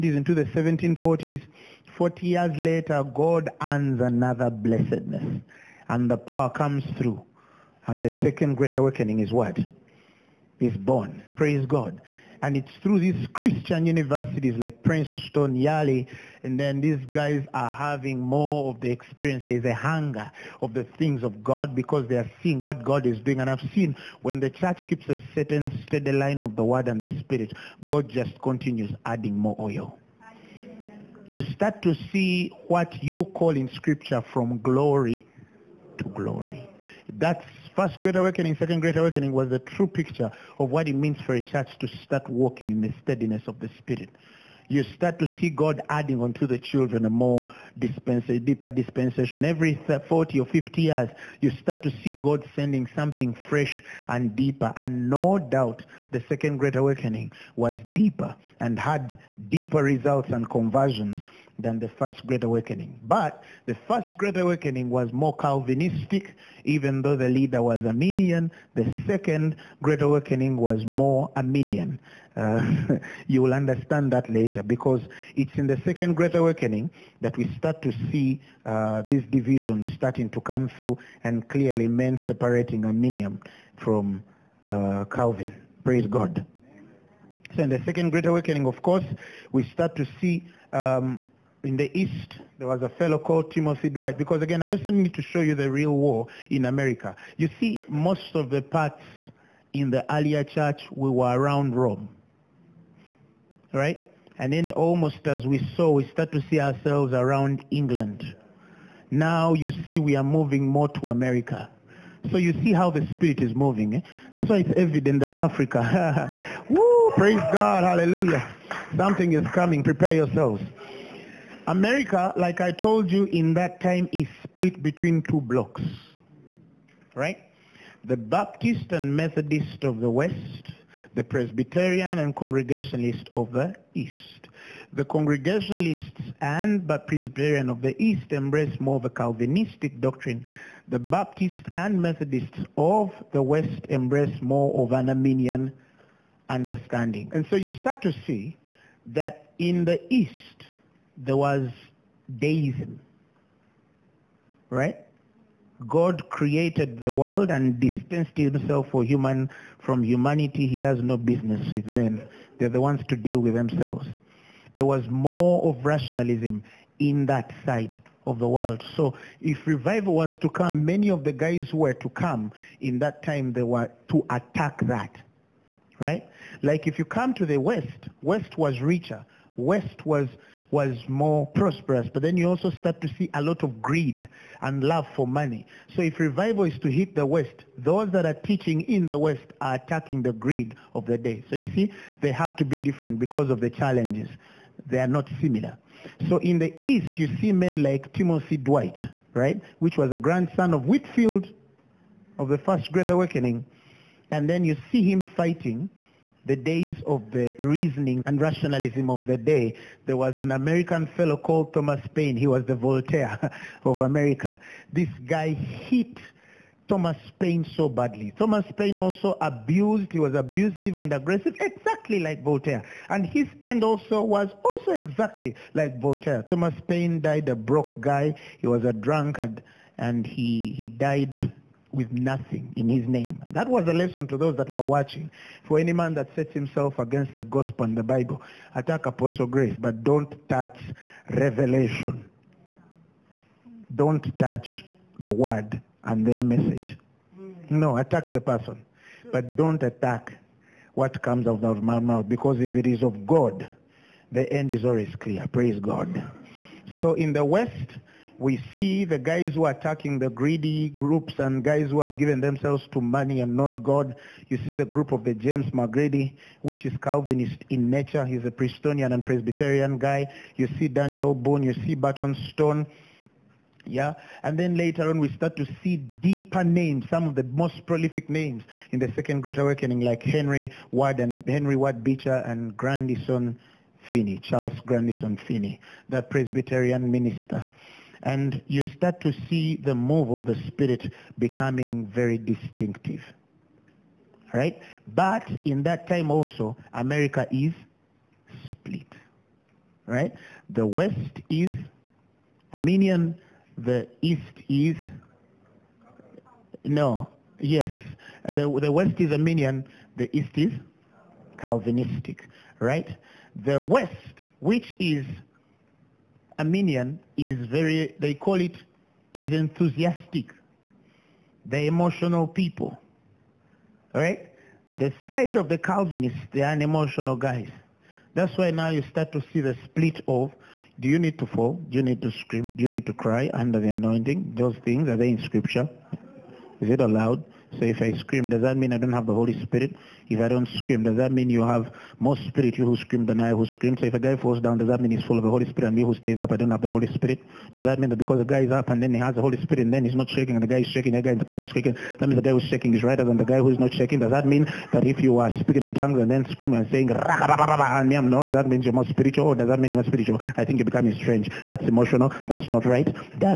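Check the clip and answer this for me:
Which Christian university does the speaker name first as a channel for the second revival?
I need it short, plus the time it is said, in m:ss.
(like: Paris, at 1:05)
Princeton, at 0:14.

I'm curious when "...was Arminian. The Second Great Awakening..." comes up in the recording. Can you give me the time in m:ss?
1:07.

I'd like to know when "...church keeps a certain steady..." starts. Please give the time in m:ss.
0:24.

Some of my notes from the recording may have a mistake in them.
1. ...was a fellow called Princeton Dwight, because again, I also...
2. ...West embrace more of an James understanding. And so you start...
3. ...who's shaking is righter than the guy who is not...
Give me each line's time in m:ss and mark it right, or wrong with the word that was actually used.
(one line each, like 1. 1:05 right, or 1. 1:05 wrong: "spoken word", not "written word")
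1. 1:32 wrong: "Timothy", not "Princeton"
2. 2:23 wrong: "Arminian", not "James"
3. 5:52 right.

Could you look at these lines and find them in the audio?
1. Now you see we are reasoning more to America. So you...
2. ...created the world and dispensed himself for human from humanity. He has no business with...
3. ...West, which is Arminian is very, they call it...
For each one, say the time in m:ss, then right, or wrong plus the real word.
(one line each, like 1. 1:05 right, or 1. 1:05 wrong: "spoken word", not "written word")
1. 1:49 wrong: "moving", not "reasoning"
2. 2:36 right
3. 5:13 right.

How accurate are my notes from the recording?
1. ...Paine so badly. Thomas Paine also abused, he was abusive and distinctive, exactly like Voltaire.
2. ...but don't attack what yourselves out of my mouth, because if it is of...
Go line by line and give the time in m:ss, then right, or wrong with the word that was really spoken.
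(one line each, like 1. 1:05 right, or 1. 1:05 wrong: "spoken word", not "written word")
1. 3:37 wrong: "aggressive", not "distinctive"
2. 4:09 wrong: "comes", not "yourselves".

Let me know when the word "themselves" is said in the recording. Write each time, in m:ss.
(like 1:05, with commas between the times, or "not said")
2:43, 4:22.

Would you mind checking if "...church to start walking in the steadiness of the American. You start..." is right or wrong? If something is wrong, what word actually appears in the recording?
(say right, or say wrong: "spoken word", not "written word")
wrong: "Spirit", not "American".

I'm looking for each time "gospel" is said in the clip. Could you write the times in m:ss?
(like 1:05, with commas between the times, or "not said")
3:57.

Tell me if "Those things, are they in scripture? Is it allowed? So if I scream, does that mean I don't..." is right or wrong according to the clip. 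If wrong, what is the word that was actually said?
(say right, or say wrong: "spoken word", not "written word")
right.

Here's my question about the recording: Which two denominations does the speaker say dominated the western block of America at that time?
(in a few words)
Baptist and Methodist.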